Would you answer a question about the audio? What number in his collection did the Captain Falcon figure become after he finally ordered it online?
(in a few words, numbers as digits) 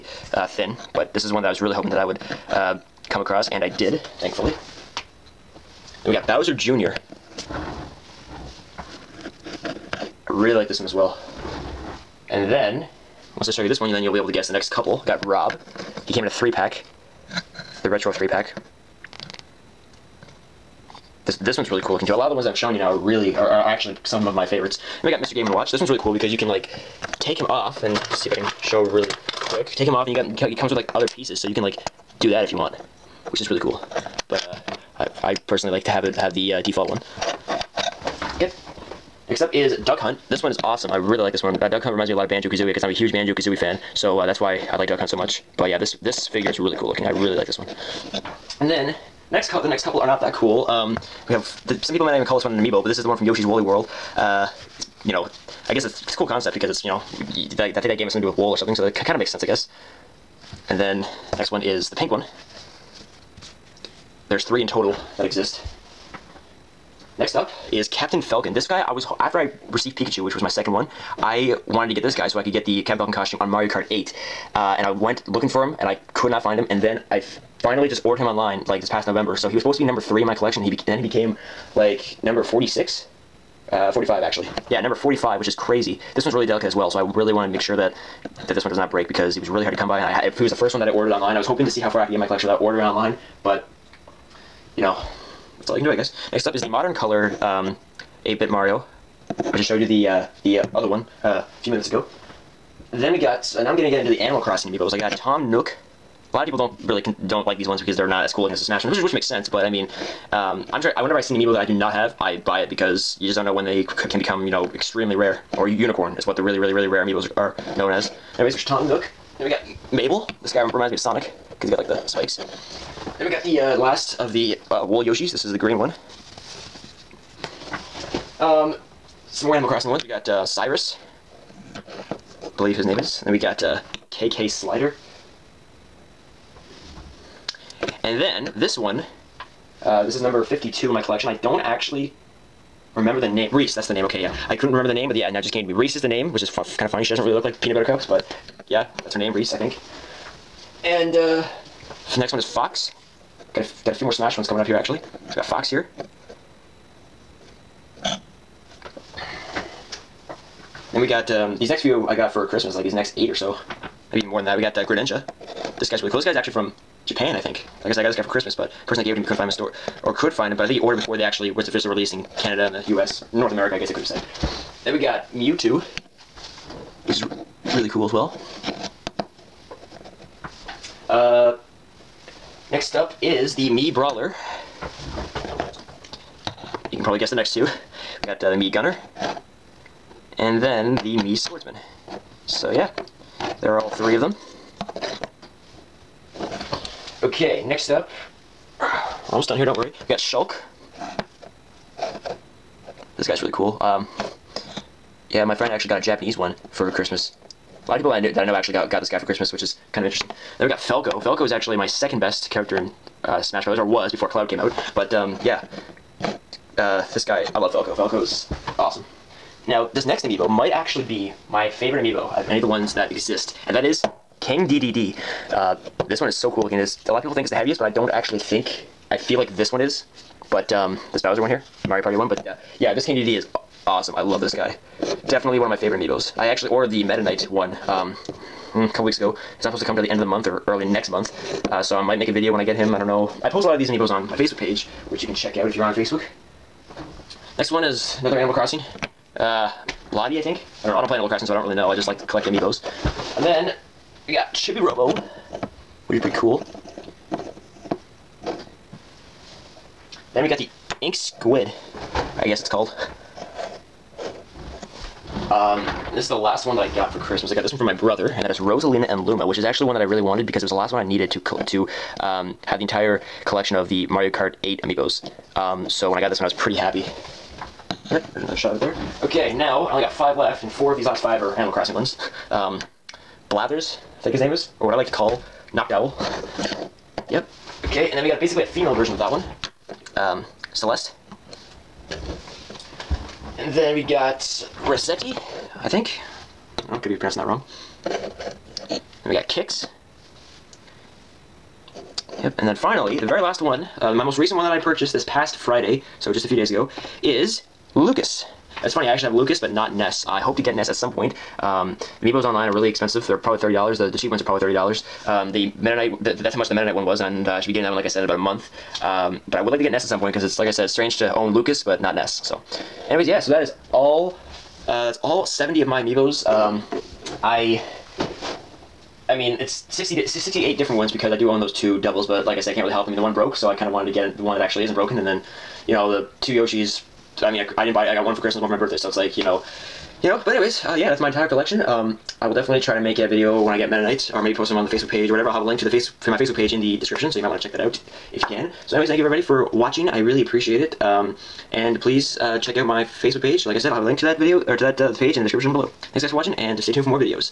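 45.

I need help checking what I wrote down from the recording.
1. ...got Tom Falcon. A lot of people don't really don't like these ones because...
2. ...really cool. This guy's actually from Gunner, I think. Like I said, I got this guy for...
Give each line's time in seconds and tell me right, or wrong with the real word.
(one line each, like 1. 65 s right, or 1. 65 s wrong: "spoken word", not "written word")
1. 104 s wrong: "Nook", not "Falcon"
2. 166 s wrong: "Japan", not "Gunner".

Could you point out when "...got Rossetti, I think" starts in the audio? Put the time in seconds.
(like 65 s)
294 s.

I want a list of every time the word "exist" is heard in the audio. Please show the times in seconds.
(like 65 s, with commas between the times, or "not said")
65 s, 223 s.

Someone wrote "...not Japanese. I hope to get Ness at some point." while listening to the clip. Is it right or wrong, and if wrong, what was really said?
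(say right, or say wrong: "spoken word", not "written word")
wrong: "Ness", not "Japanese".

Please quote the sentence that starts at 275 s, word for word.
Um, so when I got this one, I was pretty happy.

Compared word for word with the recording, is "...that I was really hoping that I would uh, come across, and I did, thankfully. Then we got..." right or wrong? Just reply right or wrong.
right.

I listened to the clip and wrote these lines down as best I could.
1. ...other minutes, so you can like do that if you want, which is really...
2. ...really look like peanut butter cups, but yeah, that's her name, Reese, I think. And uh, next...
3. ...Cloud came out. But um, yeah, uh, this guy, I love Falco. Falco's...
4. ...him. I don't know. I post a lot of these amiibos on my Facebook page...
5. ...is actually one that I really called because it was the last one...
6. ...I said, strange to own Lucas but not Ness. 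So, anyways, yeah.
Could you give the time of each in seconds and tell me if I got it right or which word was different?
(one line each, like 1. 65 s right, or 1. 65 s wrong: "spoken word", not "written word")
1. 30 s wrong: "pieces", not "minutes"
2. 147 s right
3. 214 s right
4. 242 s right
5. 269 s wrong: "wanted", not "called"
6. 320 s right.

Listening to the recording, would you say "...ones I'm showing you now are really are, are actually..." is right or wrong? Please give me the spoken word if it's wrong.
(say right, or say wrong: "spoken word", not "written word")
right.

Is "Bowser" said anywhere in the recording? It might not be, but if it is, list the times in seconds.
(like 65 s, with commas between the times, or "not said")
6 s, 231 s.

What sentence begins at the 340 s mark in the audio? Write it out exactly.
But anyways, uh, yeah, that's my entire collection.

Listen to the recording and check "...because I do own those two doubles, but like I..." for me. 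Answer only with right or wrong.
right.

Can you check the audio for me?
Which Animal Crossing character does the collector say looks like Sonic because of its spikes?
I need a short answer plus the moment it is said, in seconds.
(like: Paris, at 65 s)
Mabel, at 119 s.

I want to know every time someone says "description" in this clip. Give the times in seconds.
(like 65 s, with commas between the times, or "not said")
346 s, 355 s.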